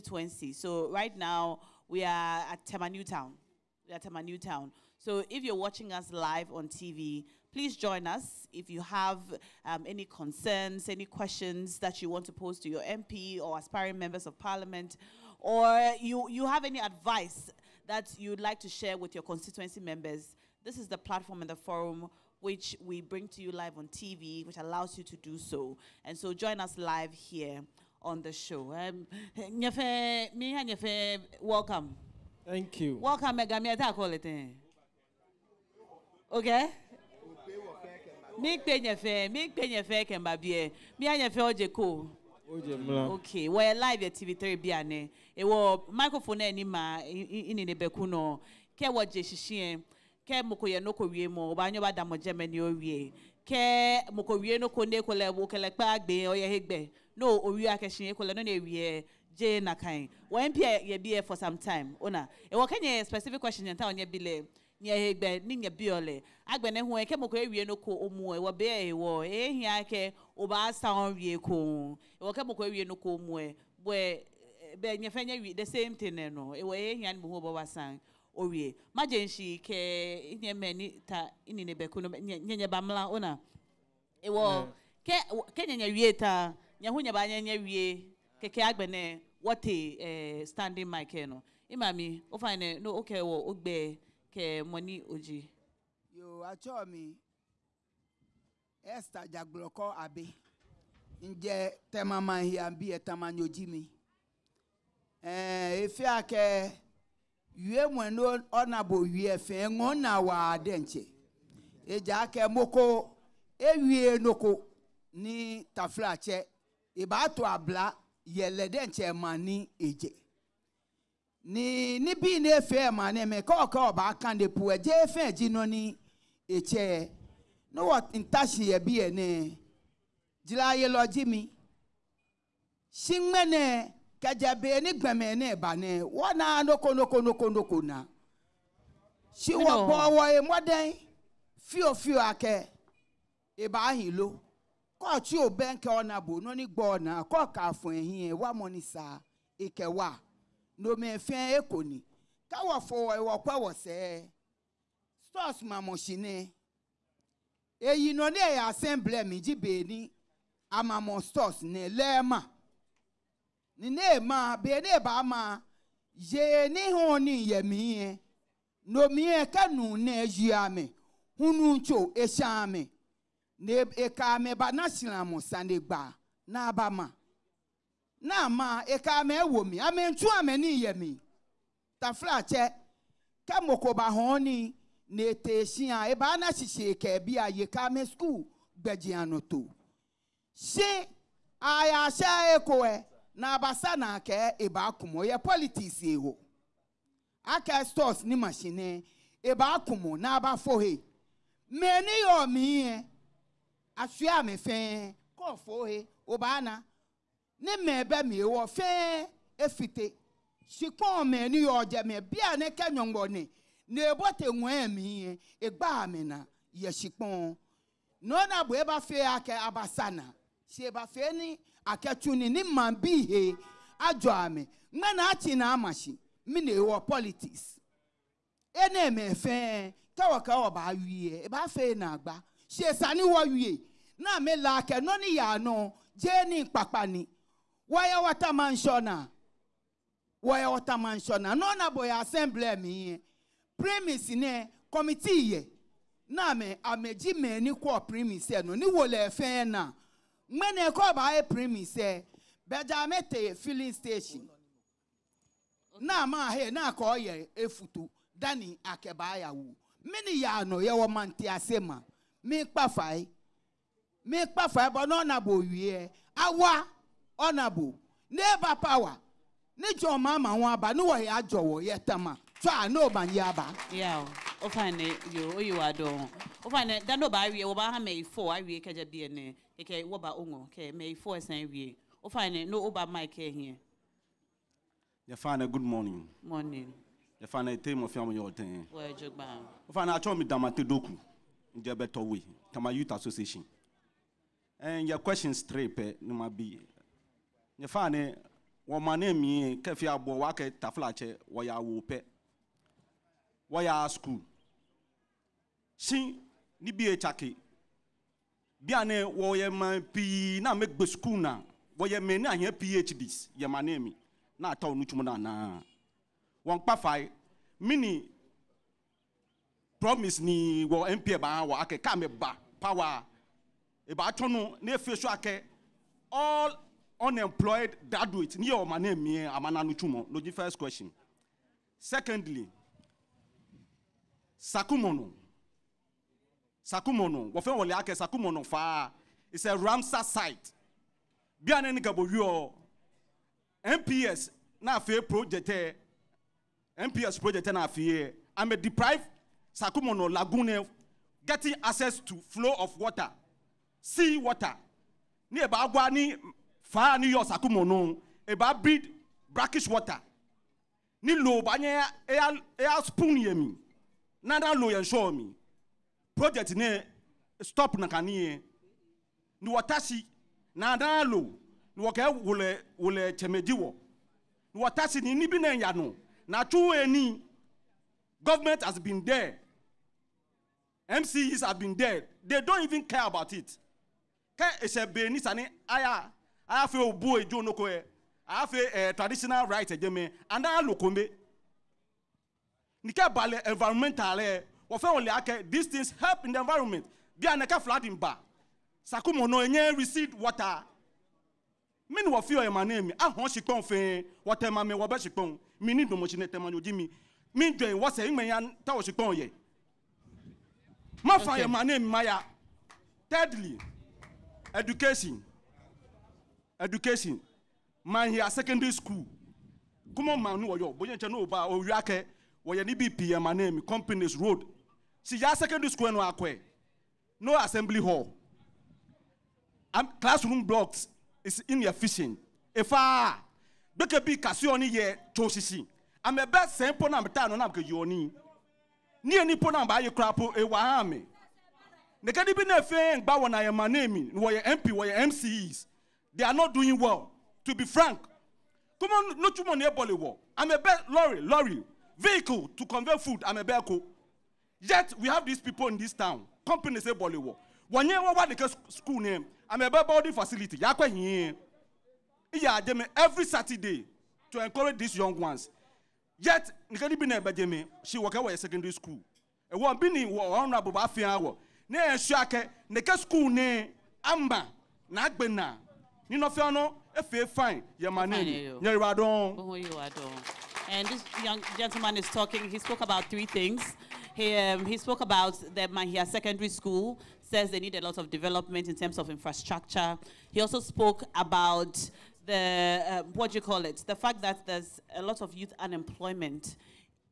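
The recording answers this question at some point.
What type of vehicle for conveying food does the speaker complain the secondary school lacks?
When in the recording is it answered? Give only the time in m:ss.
7:31.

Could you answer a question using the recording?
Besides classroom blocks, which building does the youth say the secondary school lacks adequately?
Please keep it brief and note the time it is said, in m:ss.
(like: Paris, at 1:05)
assembly hall, at 7:07.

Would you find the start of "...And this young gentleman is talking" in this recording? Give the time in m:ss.
8:00.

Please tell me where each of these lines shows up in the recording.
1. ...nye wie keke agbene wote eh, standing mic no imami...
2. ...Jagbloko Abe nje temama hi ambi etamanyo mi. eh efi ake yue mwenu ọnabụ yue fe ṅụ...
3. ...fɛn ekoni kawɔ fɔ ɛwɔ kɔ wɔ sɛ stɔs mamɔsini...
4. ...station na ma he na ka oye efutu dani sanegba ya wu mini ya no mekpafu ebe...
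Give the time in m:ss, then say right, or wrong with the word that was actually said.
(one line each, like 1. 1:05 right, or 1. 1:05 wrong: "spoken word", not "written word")
1. 1:27 right
2. 1:39 right
3. 2:31 right
4. 4:13 wrong: "akeba", not "sanegba".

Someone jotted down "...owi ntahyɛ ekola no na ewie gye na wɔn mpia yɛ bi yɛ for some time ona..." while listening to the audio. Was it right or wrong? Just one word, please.
wrong.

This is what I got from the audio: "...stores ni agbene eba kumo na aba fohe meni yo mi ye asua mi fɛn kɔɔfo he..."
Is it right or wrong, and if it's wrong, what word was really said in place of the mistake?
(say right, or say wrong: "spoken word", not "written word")
wrong: "machine", not "agbene".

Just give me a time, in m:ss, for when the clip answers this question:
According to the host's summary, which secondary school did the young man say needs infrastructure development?
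8:05.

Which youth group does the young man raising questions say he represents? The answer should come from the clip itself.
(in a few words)
Tama Youth Association.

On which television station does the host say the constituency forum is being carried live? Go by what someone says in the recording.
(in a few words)
TV3.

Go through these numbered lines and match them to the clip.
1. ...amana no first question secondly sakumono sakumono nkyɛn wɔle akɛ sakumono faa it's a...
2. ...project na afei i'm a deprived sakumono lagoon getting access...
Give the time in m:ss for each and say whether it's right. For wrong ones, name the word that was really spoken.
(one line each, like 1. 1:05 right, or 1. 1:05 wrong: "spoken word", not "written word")
1. 5:29 wrong: "wɔfɛn", not "nkyɛn"
2. 5:47 right.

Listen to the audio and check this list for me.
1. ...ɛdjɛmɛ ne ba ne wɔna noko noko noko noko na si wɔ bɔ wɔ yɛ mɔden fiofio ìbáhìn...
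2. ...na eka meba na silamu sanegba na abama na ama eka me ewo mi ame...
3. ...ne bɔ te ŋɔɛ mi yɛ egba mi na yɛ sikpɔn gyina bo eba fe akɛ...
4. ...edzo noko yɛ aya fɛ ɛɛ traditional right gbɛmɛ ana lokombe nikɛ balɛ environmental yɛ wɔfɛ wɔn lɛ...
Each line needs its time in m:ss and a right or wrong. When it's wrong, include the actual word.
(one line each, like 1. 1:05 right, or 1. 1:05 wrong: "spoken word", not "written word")
1. 2:15 wrong: "gbɛmɛ", not "ɛdjɛmɛ"
2. 2:53 right
3. 3:33 wrong: "nɔɔna", not "gyina"
4. 6:27 wrong: "ɛdjɛmɛ", not "gbɛmɛ".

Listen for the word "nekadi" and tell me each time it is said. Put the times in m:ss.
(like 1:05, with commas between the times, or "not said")
7:22, 7:46.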